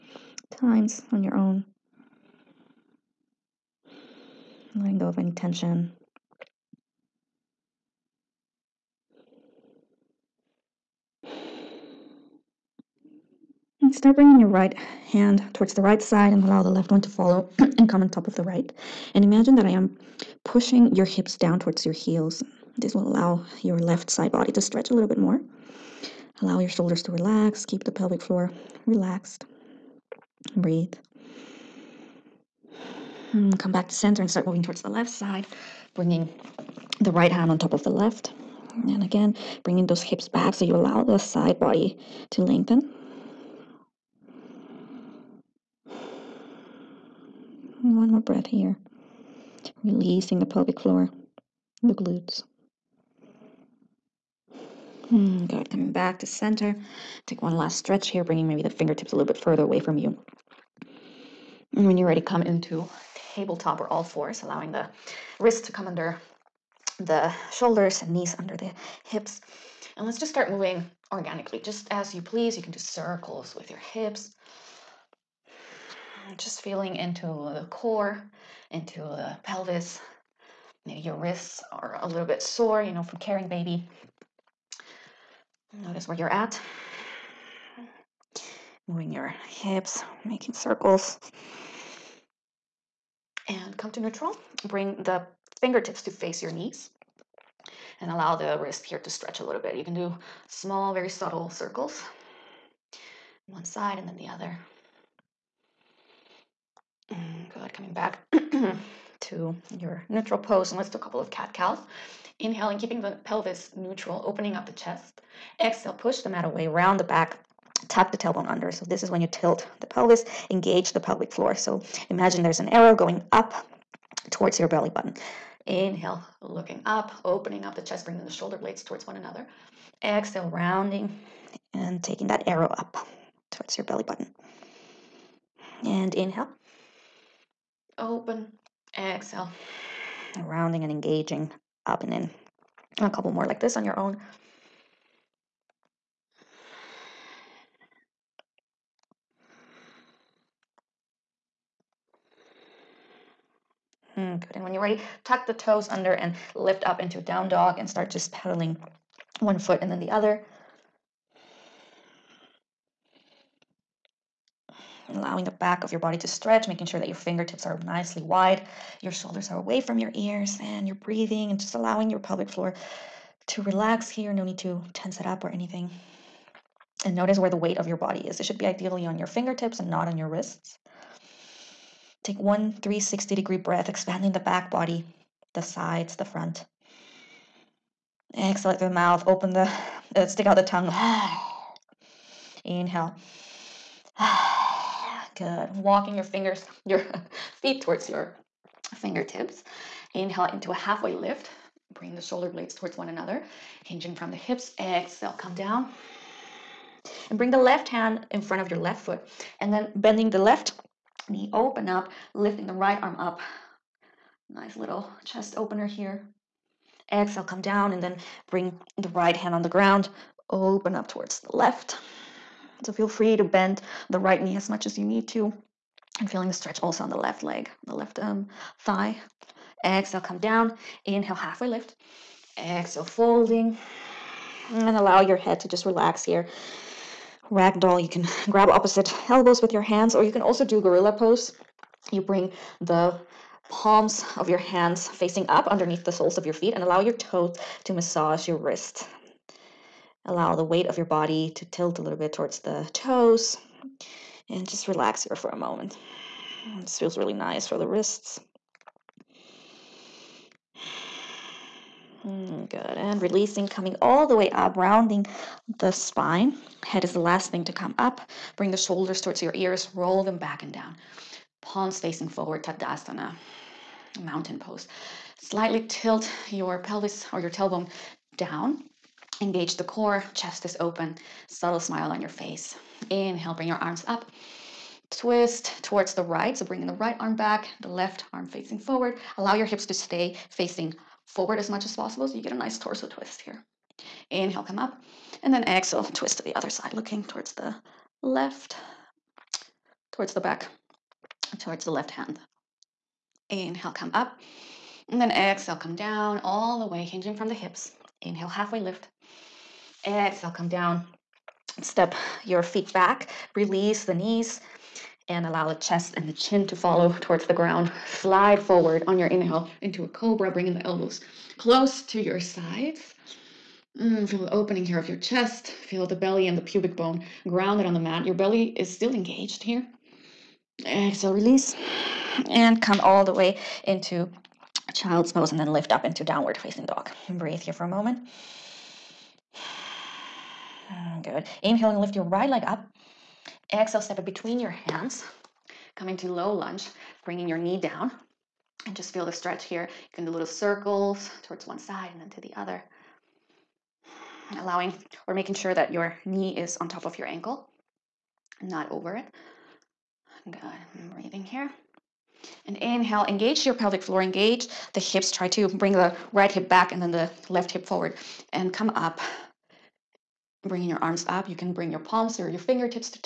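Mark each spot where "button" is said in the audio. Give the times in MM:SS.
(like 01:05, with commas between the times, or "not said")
02:04, 02:14.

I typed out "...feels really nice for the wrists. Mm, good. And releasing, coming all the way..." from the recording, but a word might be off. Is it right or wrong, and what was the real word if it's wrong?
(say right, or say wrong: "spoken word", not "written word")
right.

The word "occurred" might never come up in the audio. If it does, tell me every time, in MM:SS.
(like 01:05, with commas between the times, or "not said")
not said.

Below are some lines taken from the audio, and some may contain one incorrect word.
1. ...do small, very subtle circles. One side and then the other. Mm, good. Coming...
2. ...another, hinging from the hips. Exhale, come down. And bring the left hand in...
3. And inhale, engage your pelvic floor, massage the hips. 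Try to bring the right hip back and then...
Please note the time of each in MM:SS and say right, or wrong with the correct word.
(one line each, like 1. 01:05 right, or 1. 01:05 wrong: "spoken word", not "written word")
1. 01:39 right
2. 03:23 right
3. 06:02 wrong: "engage", not "massage".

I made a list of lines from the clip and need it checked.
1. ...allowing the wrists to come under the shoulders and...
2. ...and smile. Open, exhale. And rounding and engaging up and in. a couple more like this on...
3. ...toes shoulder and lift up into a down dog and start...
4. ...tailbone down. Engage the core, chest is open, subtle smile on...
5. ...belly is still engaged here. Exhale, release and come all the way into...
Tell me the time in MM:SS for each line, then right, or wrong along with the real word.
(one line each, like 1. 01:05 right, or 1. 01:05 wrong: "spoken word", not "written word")
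1. 01:04 right
2. 02:15 wrong: "inhale", not "smile"
3. 02:35 wrong: "under", not "shoulder"
4. 04:37 right
5. 05:28 right.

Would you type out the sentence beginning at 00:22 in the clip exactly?
This will allow your left side body to stretch a little bit more.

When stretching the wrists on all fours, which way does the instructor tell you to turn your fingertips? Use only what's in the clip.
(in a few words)
To face your knees.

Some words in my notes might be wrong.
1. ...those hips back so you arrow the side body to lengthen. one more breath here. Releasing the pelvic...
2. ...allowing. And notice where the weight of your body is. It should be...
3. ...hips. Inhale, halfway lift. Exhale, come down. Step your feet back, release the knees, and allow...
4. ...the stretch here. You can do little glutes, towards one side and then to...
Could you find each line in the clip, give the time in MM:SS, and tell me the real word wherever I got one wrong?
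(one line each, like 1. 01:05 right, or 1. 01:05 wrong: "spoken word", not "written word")
1. 00:39 wrong: "allow", not "arrow"
2. 02:55 wrong: "anything", not "allowing"
3. 05:07 right
4. 05:49 wrong: "circles", not "glutes".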